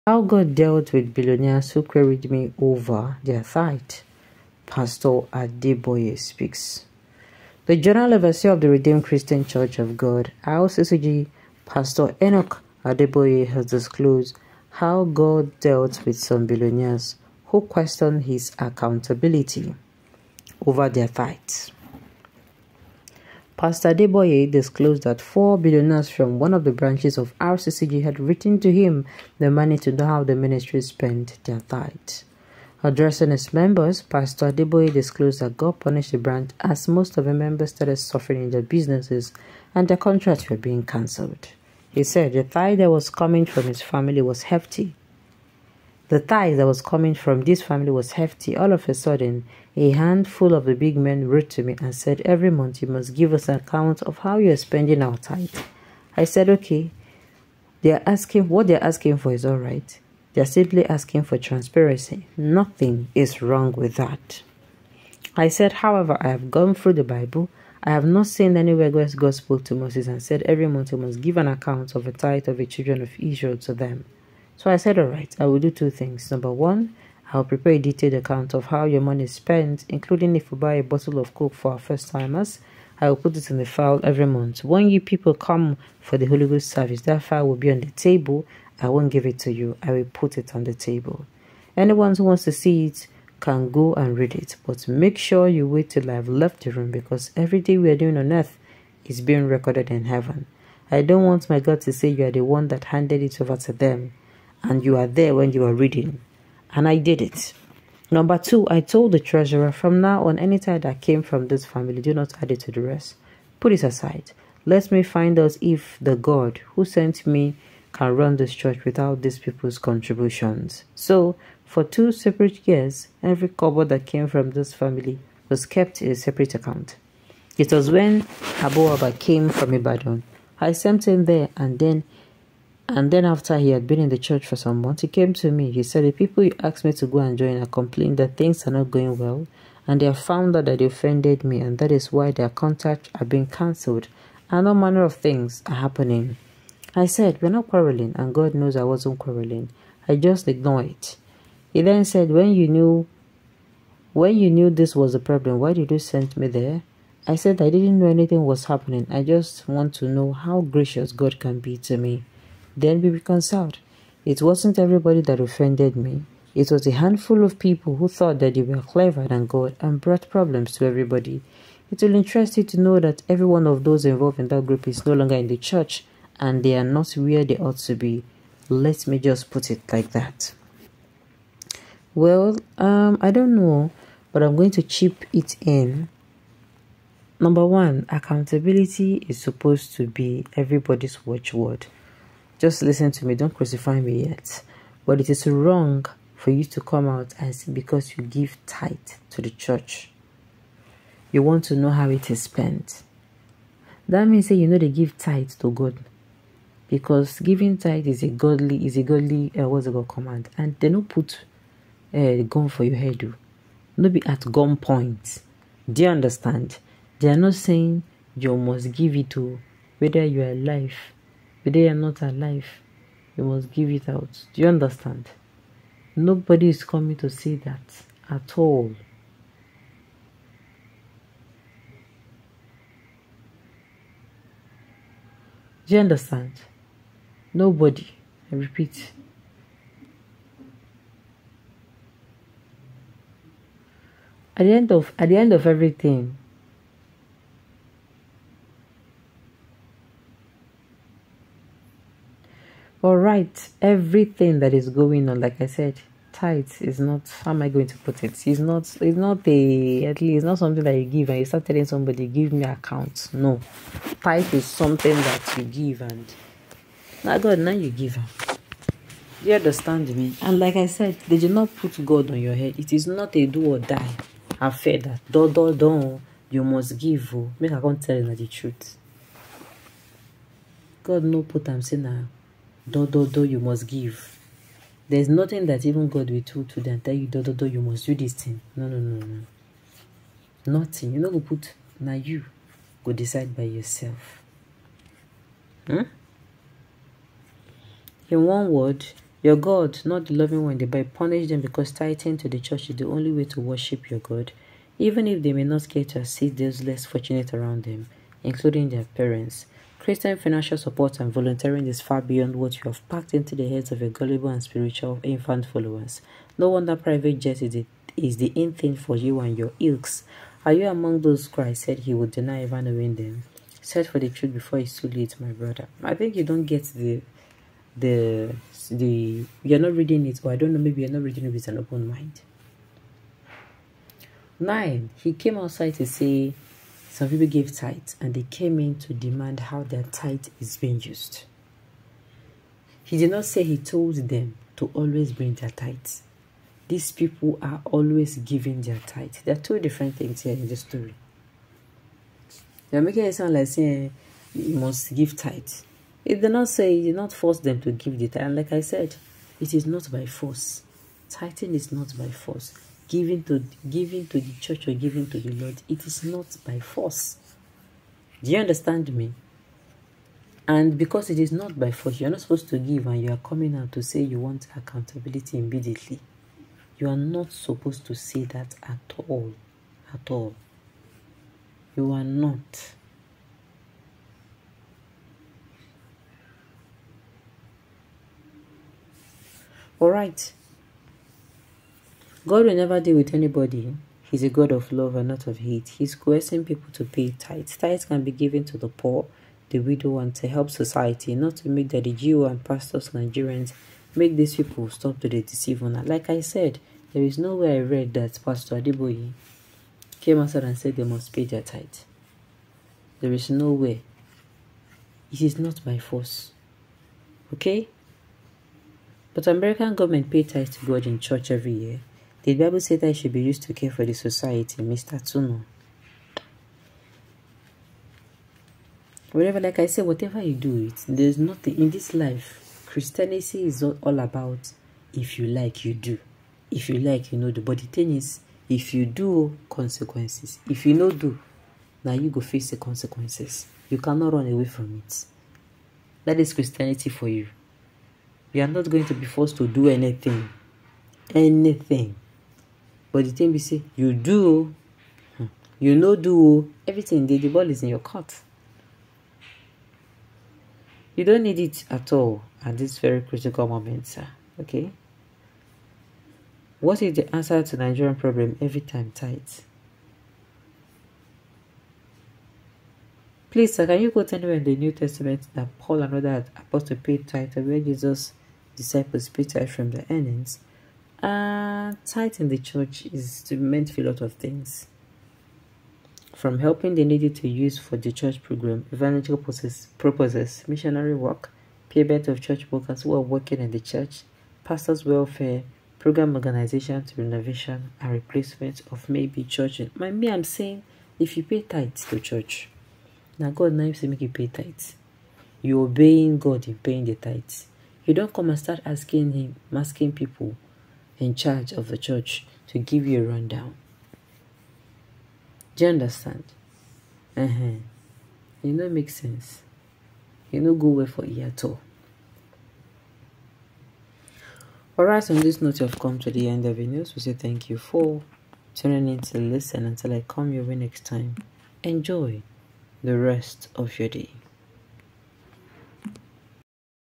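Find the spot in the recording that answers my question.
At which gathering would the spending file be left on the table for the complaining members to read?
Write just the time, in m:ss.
1:26.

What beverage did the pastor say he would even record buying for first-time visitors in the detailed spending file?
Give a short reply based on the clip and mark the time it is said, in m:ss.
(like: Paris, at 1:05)
A bottle of Coke, at 1:20.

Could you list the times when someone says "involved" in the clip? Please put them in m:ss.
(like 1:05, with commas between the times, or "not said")
2:54.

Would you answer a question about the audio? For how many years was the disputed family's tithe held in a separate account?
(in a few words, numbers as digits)
2.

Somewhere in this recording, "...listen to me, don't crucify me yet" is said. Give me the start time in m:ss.
3:12.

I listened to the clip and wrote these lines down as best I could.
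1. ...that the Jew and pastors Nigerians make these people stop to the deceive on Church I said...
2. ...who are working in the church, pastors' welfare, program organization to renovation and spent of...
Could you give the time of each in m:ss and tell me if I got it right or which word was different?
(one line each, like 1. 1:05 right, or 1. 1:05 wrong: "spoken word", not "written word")
1. 6:41 wrong: "Like", not "Church"
2. 8:13 wrong: "replacement", not "spent".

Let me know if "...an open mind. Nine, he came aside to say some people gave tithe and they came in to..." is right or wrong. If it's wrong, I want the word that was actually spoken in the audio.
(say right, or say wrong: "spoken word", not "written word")
wrong: "outside", not "aside".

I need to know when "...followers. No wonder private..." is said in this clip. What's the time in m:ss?
5:15.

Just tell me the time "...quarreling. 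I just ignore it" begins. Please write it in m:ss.
2:29.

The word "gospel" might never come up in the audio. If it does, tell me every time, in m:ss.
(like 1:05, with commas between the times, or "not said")
1:09.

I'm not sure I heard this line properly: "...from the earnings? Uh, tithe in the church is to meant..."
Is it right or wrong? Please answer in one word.
right.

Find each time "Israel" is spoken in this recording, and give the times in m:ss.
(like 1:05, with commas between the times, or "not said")
1:13.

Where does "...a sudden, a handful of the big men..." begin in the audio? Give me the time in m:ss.
0:48.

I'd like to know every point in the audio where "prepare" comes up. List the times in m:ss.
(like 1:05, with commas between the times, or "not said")
1:17.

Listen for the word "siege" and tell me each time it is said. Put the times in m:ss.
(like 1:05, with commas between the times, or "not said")
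not said.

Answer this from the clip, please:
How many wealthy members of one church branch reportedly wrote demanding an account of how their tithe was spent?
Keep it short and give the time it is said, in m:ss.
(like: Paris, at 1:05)
4, at 0:25.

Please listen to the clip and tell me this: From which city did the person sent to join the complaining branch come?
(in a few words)
Ibadan.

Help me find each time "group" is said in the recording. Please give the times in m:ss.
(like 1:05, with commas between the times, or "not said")
2:54.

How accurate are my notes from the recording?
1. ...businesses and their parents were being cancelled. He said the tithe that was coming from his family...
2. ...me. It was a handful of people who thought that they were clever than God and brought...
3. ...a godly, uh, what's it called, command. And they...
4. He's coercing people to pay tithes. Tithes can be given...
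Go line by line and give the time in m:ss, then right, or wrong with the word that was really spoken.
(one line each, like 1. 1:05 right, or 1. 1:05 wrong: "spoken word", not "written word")
1. 0:38 wrong: "contracts", not "parents"
2. 2:45 right
3. 3:28 right
4. 6:35 right.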